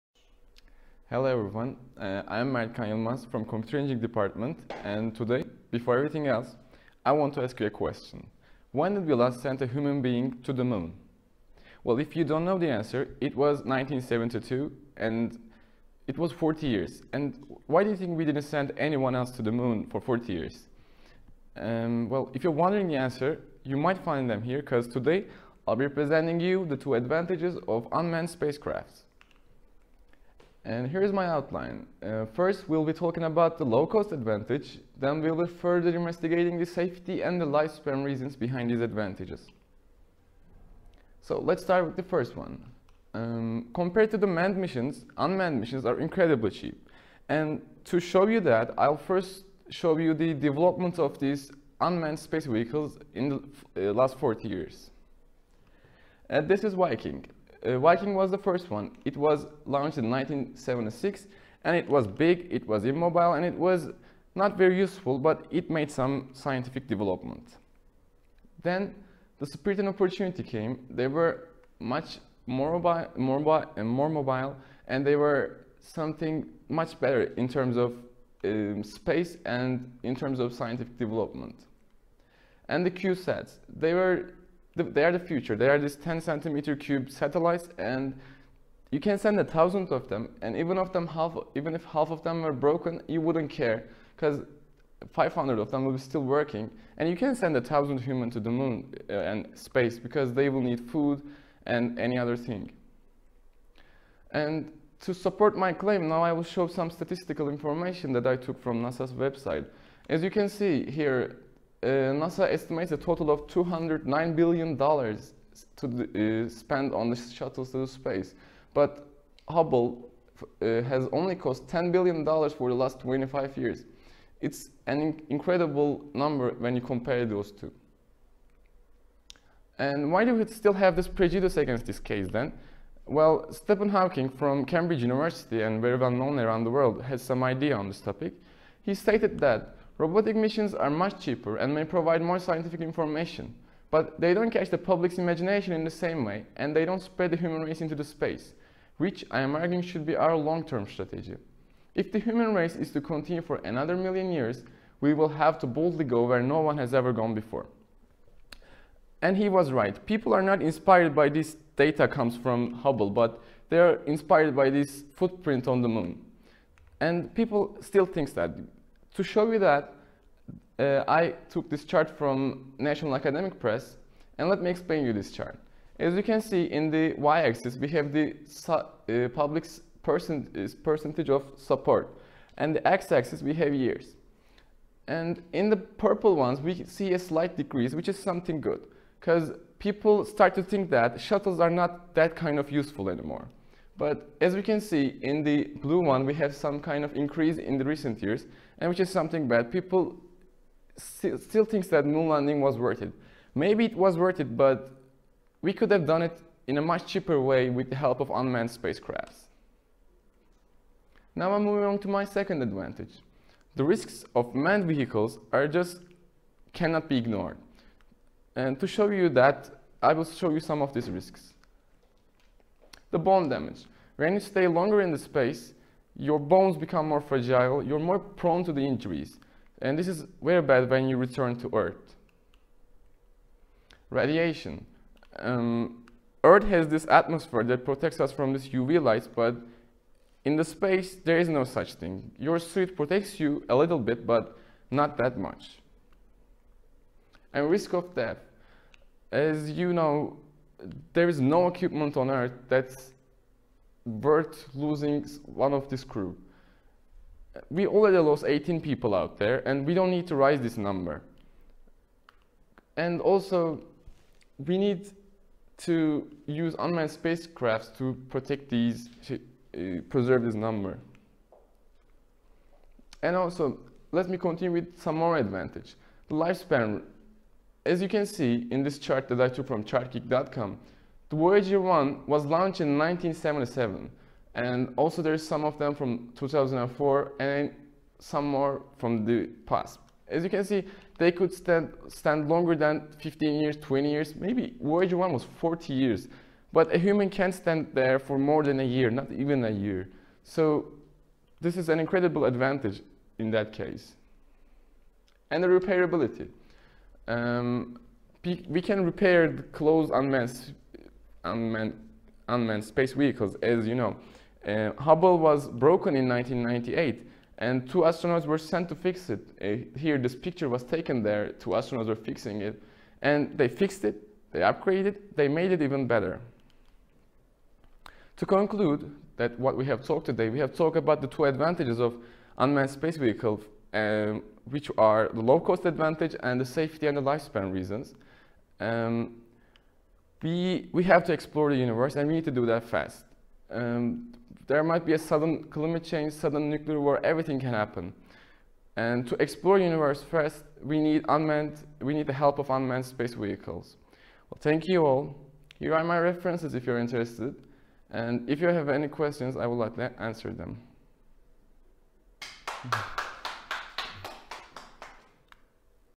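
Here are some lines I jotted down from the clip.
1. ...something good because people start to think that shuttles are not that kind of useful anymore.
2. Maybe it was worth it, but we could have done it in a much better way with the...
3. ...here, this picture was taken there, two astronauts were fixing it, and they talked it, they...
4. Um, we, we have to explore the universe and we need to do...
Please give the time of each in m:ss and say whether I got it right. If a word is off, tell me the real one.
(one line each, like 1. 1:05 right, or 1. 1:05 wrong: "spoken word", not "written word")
1. 3:08 right
2. 3:23 wrong: "cheaper", not "better"
3. 5:19 wrong: "fixed", not "talked"
4. 5:38 right.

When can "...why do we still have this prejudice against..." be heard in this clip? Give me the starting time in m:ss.
2:10.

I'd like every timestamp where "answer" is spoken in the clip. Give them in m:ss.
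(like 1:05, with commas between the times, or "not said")
0:12, 0:22, 6:00.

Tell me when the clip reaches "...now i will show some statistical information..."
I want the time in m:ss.
1:46.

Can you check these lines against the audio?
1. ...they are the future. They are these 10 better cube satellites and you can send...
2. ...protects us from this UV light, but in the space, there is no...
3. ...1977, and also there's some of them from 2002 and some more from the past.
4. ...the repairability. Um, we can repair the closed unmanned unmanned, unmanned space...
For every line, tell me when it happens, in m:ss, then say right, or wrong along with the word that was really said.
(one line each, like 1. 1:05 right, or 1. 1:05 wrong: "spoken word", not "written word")
1. 1:24 wrong: "centimeter", not "better"
2. 3:57 right
3. 4:42 wrong: "2004", not "2002"
4. 5:05 right.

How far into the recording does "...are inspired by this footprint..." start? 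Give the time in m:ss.
2:43.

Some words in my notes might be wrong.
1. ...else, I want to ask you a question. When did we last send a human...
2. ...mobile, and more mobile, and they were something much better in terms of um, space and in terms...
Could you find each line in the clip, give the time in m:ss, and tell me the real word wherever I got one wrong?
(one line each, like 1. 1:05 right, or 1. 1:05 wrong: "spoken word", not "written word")
1. 0:06 right
2. 1:13 right.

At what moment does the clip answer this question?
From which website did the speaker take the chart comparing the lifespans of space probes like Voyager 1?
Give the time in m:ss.
4:39.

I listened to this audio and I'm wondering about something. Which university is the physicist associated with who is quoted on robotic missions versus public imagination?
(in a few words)
Cambridge University.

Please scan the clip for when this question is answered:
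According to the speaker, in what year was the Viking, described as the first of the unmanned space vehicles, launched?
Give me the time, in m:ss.
1:00.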